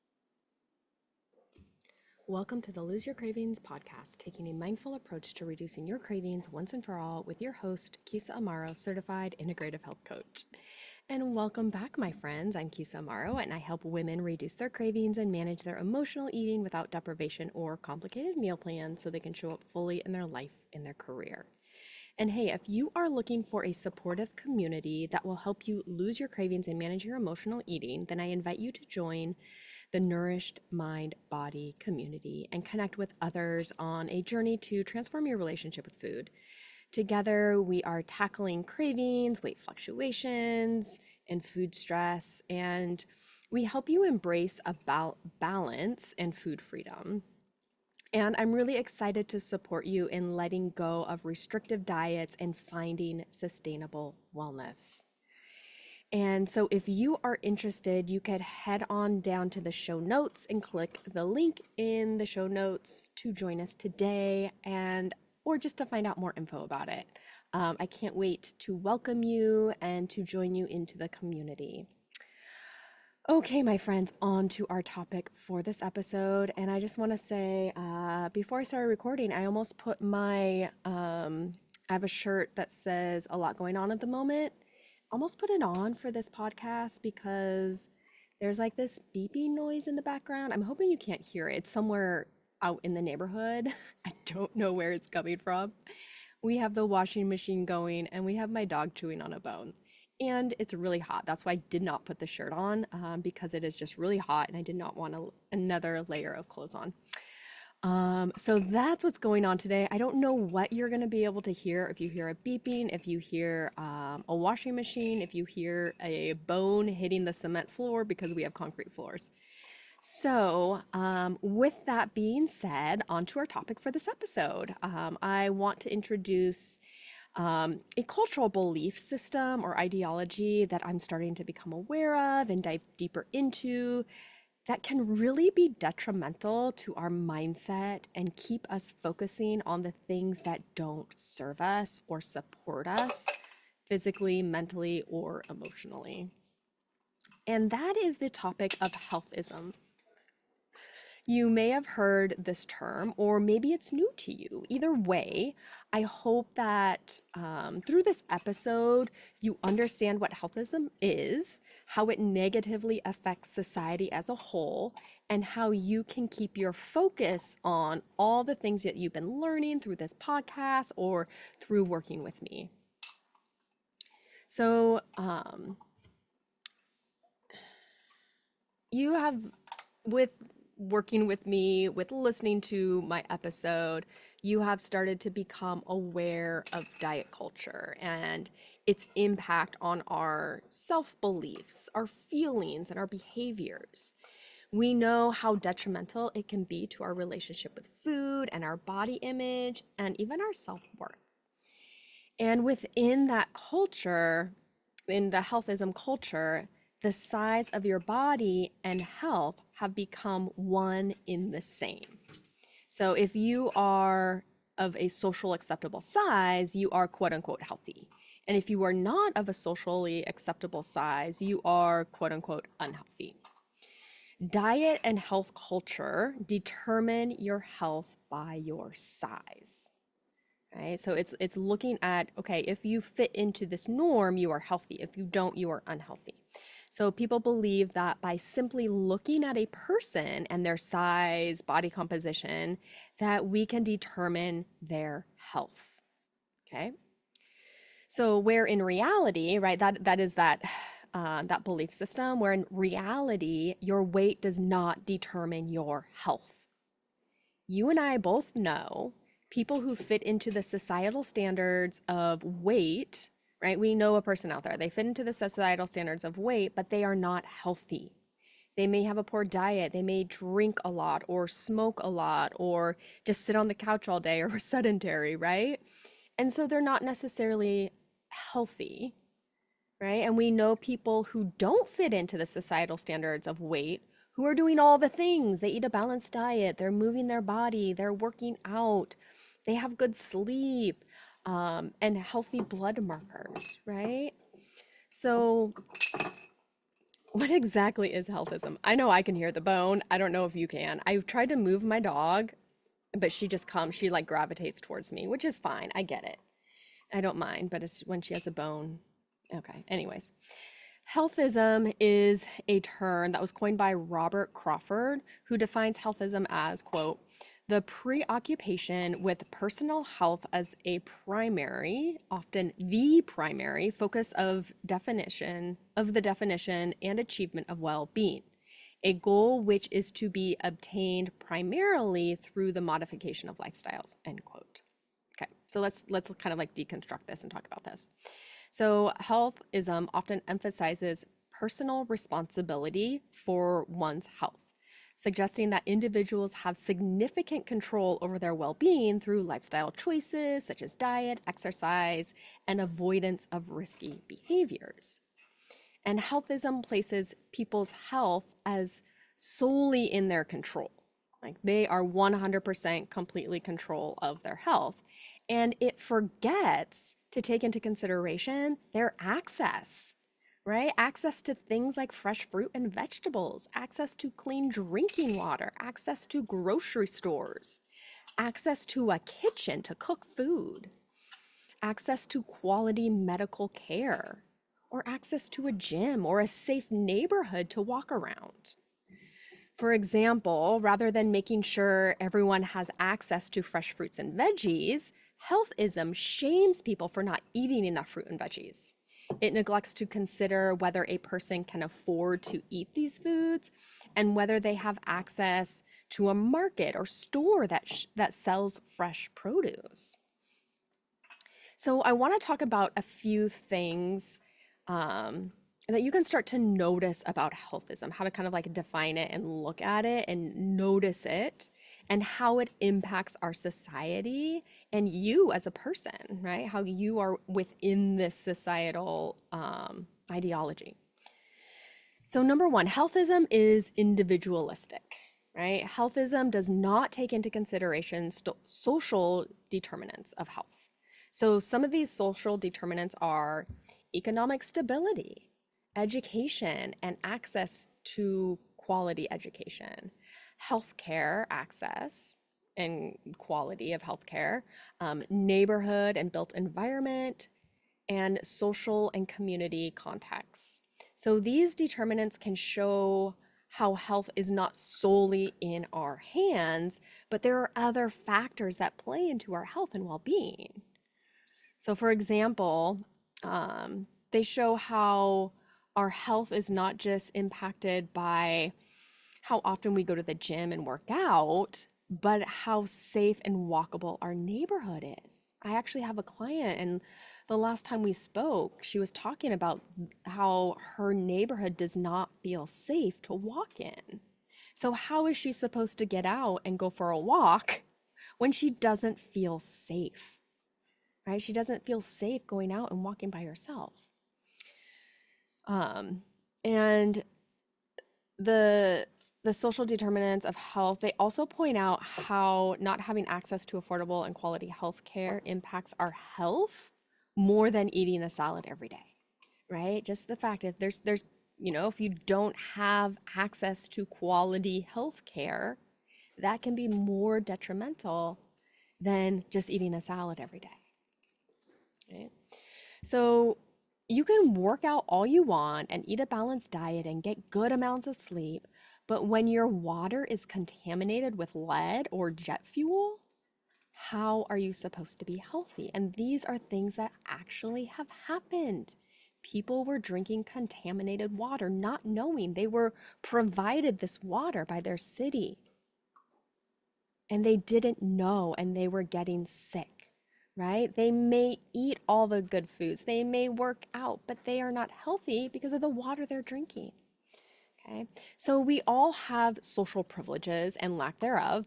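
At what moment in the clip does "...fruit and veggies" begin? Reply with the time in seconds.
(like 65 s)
398 s.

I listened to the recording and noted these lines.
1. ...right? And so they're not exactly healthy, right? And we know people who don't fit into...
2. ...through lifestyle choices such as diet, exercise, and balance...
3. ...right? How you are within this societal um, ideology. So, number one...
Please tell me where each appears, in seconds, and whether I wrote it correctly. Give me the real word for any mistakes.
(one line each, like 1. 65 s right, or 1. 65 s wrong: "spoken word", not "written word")
1. 275 s wrong: "necessarily", not "exactly"
2. 349 s wrong: "avoidance", not "balance"
3. 426 s right.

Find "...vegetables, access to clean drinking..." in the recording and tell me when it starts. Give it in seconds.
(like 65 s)
372 s.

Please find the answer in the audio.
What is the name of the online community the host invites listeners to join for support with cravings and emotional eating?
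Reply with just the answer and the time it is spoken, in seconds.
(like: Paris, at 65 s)
Nourished Mind Body community, at 30 s.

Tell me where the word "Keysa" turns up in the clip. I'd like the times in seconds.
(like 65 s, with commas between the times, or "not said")
8 s, 12 s.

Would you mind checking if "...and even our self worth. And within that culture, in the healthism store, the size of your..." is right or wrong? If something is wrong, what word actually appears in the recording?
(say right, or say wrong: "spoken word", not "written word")
wrong: "culture", not "store".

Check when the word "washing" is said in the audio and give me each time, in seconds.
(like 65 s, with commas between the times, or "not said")
96 s, 114 s.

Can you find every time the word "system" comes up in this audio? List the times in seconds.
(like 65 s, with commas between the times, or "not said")
128 s, 251 s.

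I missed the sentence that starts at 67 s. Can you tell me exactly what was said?
Um, I can't wait to welcome you and to join you into the community.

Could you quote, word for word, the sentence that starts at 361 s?
Like they are 100% completely control of their health.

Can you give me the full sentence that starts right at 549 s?
People were drinking contaminated water, not knowing they were provided this water by their city.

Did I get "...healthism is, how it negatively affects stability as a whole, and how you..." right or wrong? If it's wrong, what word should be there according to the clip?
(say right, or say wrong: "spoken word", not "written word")
wrong: "society", not "stability".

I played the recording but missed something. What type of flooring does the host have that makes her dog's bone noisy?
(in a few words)
Concrete floors.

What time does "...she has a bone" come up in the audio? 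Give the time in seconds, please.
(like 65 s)
308 s.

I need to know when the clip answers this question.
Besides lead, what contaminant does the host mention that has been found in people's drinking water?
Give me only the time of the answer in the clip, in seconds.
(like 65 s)
542 s.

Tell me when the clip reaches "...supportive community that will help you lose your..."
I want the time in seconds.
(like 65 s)
23 s.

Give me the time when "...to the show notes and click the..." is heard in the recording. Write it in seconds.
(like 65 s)
59 s.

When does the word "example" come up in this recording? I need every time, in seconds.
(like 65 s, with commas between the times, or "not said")
389 s, 472 s.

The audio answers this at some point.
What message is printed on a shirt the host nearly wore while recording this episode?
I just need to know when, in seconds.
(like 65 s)
83 s.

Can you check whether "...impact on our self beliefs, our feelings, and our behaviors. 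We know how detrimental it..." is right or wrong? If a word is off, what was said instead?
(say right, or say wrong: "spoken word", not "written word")
right.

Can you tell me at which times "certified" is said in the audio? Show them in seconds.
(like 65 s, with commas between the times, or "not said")
8 s.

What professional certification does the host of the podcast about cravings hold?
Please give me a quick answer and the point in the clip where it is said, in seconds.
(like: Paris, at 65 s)
Integrative health coach, at 9 s.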